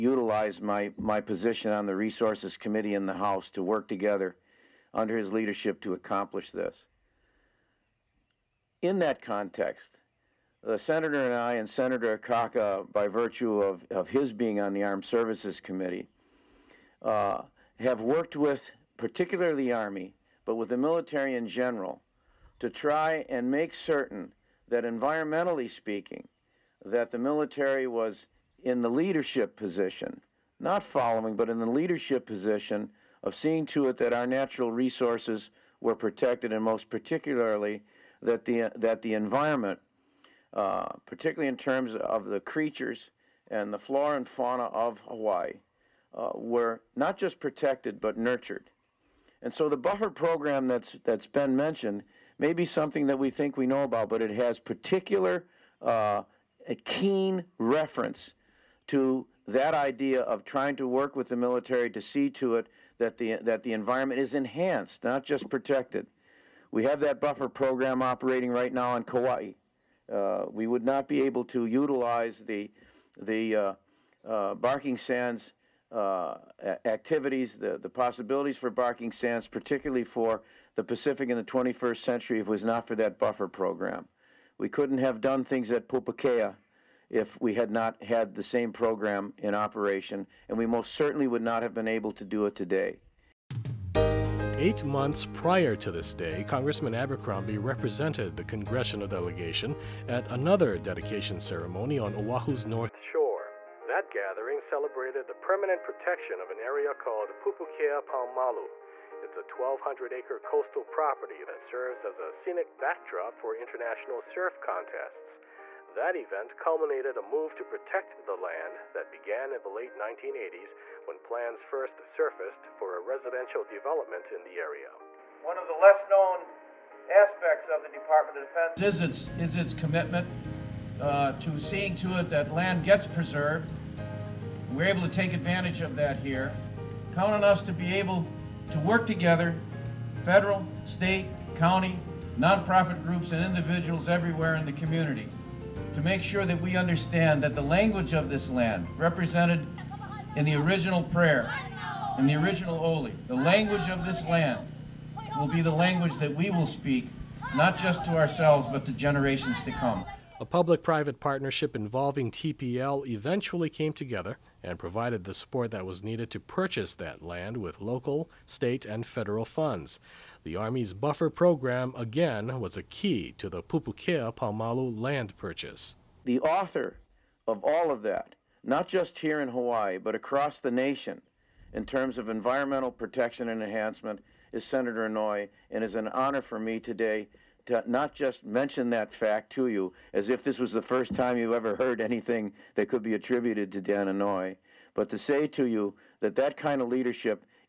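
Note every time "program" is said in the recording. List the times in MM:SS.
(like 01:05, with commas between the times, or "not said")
00:50, 01:07, 01:23, 01:28, 02:51.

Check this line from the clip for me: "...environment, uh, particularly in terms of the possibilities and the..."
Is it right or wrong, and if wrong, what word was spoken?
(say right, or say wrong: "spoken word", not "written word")
wrong: "creatures", not "possibilities".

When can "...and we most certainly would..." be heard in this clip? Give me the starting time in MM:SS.
01:30.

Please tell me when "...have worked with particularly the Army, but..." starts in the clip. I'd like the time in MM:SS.
00:17.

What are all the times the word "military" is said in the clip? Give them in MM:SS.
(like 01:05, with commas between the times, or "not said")
00:20, 00:27, 01:01.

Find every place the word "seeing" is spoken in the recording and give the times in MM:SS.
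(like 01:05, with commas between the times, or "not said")
00:33, 02:11.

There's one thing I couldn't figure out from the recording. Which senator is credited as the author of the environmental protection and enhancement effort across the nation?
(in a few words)
Senator Inouye.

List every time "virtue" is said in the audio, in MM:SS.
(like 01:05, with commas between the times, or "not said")
00:13.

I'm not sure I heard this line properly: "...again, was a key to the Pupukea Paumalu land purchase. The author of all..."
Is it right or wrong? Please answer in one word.
right.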